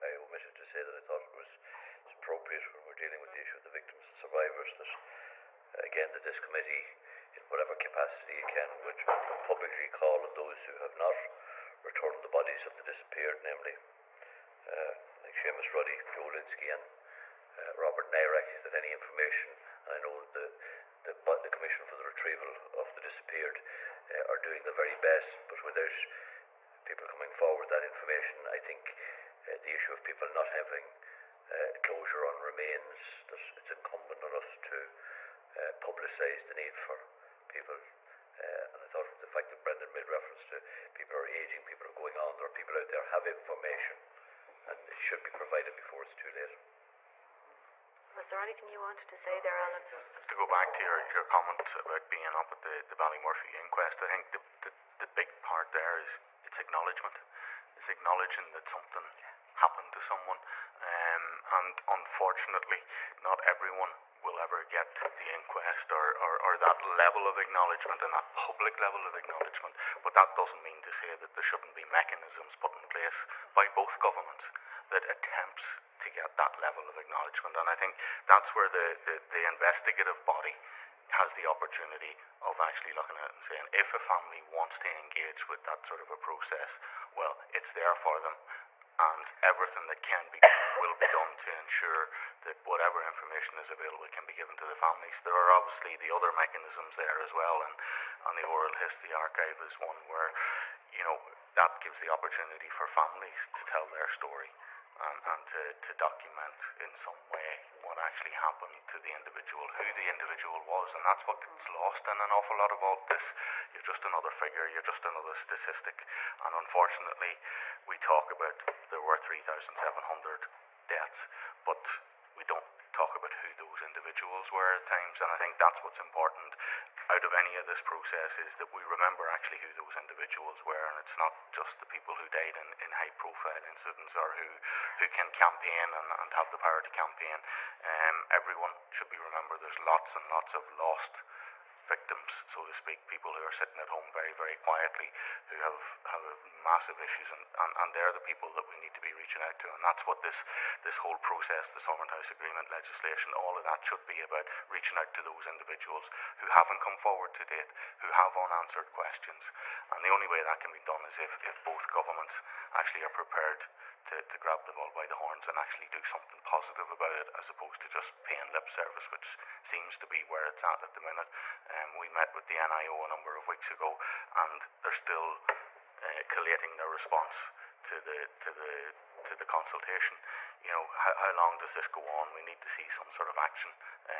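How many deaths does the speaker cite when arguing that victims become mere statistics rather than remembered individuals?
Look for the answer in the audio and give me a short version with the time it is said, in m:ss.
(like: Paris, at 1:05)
3,700, at 1:59.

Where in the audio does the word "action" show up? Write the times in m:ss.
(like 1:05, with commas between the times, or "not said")
3:03.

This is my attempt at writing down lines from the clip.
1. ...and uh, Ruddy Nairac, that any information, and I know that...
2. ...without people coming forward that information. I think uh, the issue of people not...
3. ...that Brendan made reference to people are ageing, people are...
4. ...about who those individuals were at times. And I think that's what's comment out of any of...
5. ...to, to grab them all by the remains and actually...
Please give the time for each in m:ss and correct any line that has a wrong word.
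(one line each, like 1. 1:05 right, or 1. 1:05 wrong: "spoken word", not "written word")
1. 0:16 wrong: "Robert", not "Ruddy"
2. 0:25 right
3. 0:39 right
4. 2:03 wrong: "important", not "comment"
5. 2:44 wrong: "horns", not "remains".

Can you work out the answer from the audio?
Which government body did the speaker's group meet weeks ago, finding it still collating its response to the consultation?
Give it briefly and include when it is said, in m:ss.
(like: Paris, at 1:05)
NIO, at 2:52.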